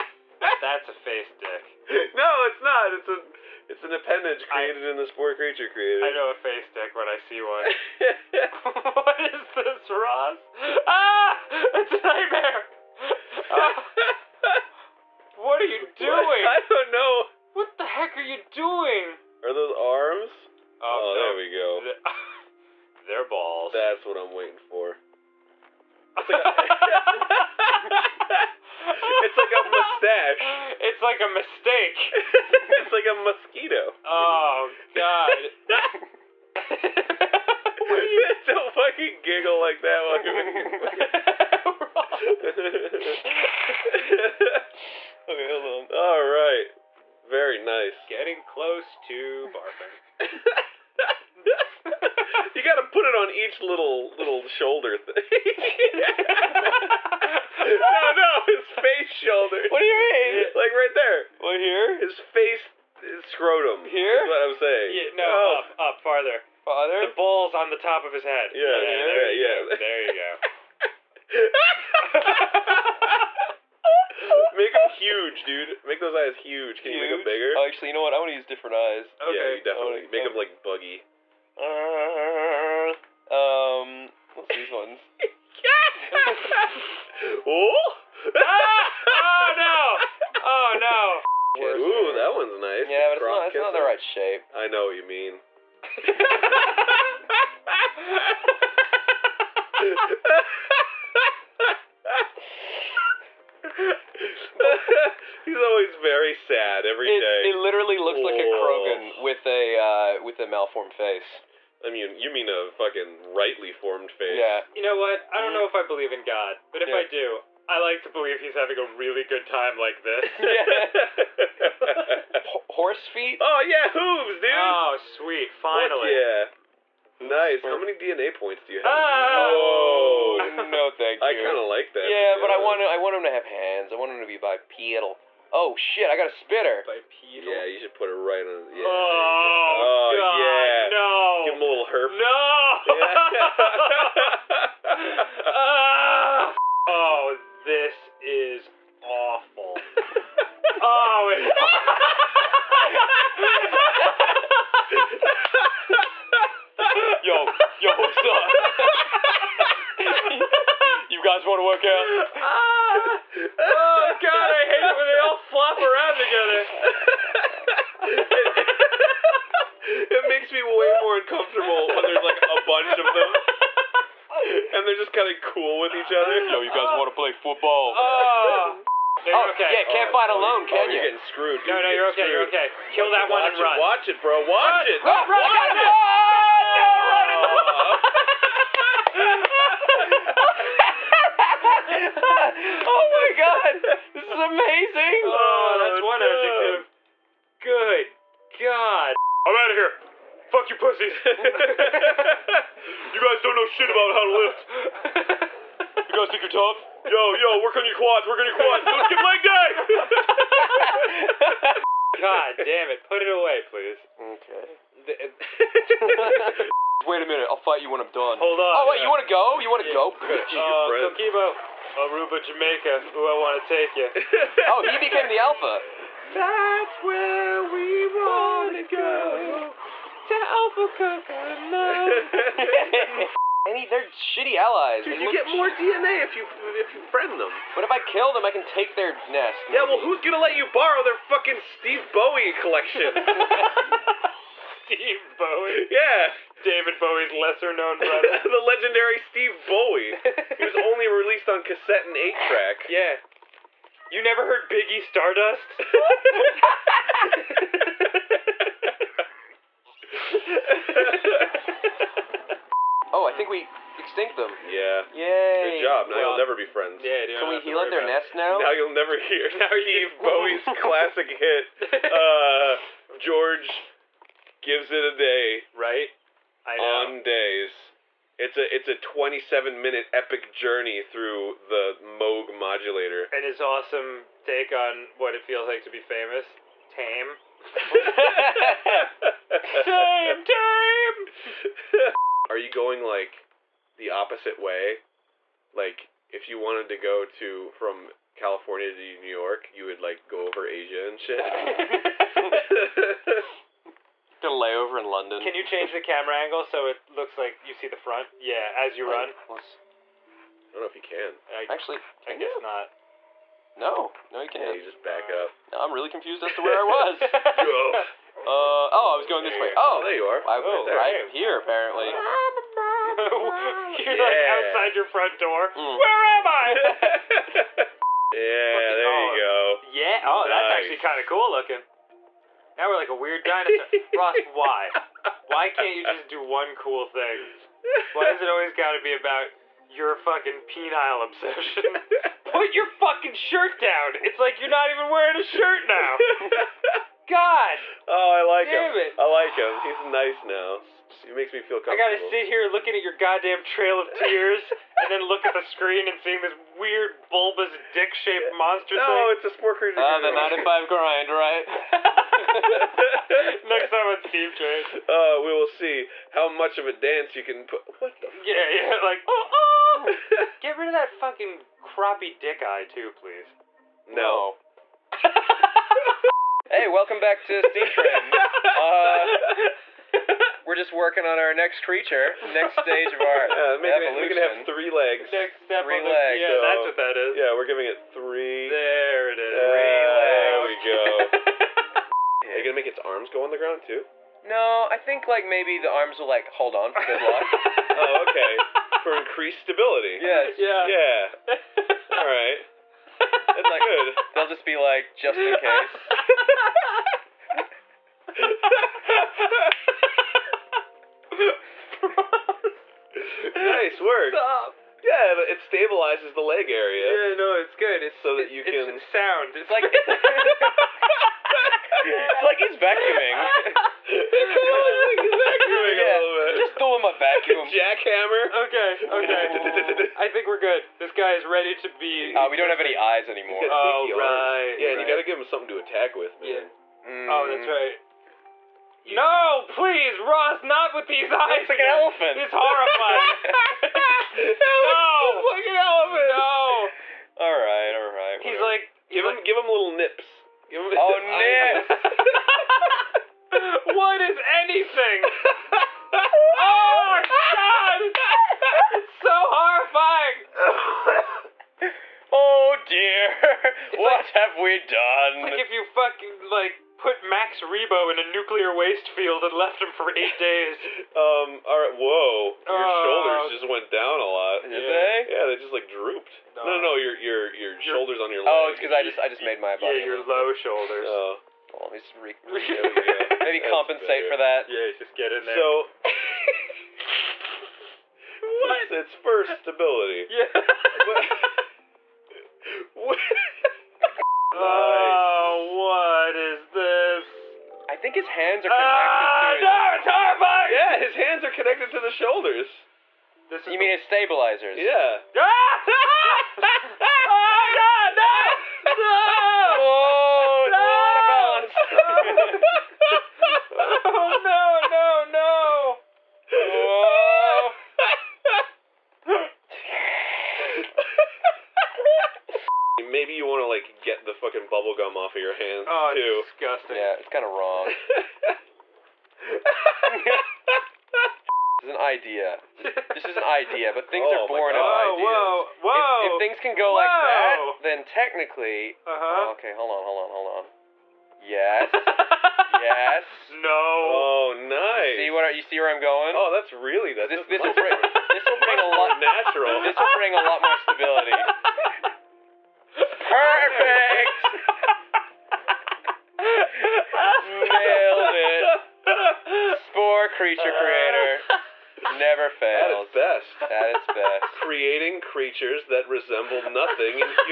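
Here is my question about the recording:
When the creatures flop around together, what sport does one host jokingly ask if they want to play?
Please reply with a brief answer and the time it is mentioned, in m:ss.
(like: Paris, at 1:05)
Football, at 2:57.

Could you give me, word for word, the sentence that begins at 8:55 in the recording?
Whoa, whoa, if, if things can go whoa.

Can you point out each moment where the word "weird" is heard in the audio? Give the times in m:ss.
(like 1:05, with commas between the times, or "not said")
5:33, 5:56.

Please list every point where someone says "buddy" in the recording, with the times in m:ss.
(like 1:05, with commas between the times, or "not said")
not said.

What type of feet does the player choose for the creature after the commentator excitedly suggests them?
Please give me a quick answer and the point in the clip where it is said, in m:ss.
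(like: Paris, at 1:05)
Hooves, at 2:03.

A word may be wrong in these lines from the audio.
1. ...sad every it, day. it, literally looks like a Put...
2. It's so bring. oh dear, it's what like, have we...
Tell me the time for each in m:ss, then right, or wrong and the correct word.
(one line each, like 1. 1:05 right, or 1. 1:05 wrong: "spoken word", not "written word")
1. 1:46 wrong: "Krogan", not "Put"
2. 7:39 wrong: "horrifying", not "bring".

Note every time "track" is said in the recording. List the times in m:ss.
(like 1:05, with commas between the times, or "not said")
4:12.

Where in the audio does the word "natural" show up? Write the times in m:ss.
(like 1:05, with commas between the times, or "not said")
9:09.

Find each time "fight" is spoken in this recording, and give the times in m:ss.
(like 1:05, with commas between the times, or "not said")
3:00, 3:37.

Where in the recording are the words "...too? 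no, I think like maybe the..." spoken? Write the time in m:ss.
6:33.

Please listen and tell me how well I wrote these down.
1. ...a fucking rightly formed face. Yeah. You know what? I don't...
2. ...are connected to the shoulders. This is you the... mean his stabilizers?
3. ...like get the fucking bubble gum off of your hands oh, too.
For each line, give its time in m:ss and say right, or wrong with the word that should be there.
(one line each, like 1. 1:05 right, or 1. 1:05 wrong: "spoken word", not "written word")
1. 1:52 right
2. 8:21 right
3. 8:43 right.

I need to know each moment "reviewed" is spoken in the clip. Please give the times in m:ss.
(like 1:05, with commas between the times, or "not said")
not said.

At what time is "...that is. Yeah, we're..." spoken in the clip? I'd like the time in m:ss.
6:26.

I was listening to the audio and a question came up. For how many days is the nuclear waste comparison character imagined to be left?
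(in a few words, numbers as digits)
8.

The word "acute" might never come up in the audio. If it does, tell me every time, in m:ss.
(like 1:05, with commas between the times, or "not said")
not said.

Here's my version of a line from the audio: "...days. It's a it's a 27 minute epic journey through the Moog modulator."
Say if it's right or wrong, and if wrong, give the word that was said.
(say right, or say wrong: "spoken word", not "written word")
right.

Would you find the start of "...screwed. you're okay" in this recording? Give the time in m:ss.
3:02.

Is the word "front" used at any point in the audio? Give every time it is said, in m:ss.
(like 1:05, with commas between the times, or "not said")
5:07, 5:25.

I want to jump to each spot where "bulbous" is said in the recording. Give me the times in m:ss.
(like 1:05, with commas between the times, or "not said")
5:57.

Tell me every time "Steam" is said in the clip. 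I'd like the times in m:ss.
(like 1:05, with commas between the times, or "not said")
6:04, 6:17.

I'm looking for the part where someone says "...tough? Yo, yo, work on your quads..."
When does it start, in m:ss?
3:26.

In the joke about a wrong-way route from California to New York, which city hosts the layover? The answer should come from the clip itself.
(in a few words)
London.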